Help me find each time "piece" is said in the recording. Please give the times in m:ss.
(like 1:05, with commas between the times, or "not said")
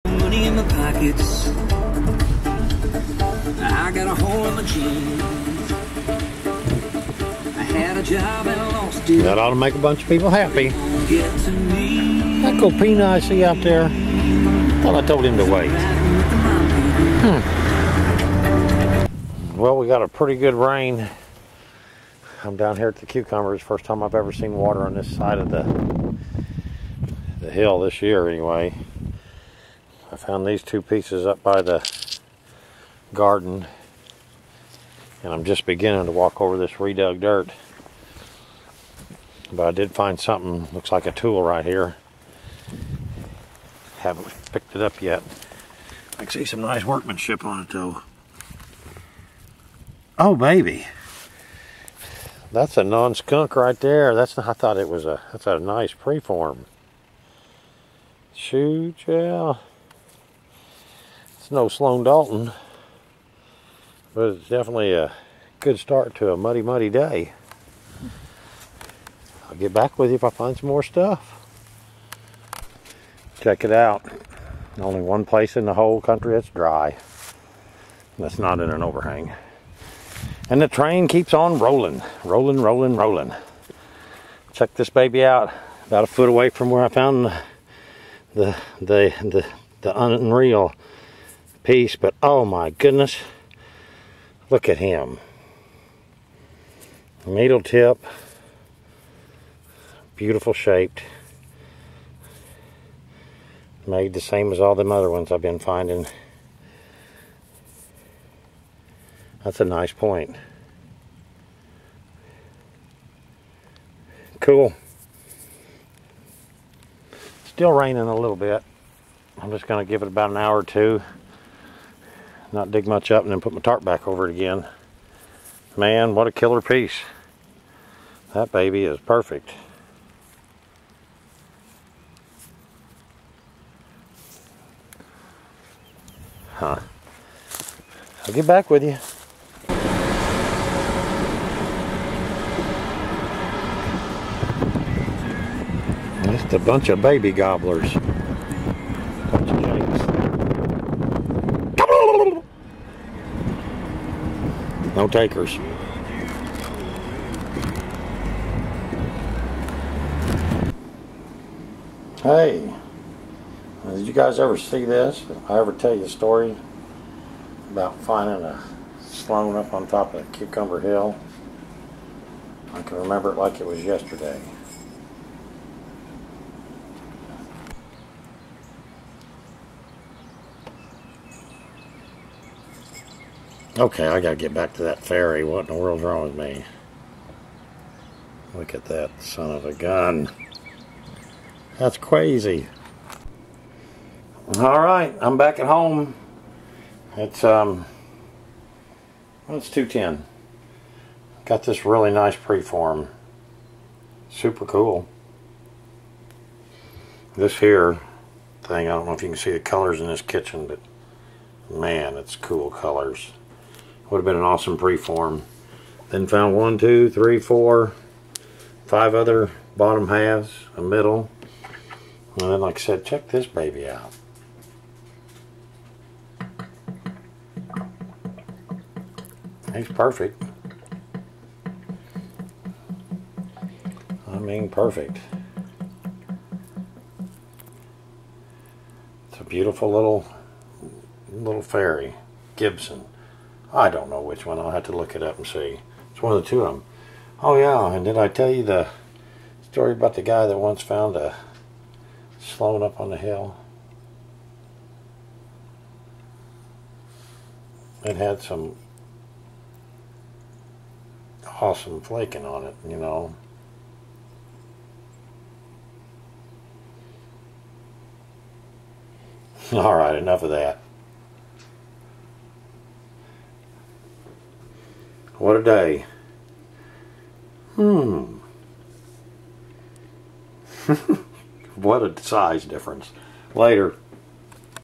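0:30, 1:31, 2:06.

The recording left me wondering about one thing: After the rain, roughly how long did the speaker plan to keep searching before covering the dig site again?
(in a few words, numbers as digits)
An hour or two.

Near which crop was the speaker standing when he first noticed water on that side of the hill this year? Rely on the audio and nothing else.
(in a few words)
Cucumbers.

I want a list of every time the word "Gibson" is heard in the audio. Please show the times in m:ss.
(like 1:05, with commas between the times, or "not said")
4:02.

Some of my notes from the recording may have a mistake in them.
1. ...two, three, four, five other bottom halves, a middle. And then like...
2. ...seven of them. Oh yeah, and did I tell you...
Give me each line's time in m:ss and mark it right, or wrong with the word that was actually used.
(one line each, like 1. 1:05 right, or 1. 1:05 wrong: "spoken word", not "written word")
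1. 3:36 right
2. 4:06 wrong: "two", not "seven".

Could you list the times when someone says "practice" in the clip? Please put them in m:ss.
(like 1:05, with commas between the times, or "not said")
not said.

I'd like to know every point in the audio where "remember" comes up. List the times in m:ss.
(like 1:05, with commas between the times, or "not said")
2:52.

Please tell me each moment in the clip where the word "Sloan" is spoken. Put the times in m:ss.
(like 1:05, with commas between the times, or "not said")
1:01, 2:49, 4:12.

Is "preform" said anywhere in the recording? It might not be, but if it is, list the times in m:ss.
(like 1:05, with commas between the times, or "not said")
0:55, 3:22, 3:34.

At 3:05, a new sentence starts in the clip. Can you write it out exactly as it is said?
What in the world's wrong with me?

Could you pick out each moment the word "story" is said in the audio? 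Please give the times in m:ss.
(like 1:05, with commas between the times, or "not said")
2:46, 4:09.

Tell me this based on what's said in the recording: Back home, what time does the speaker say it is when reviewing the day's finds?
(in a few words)
2:10.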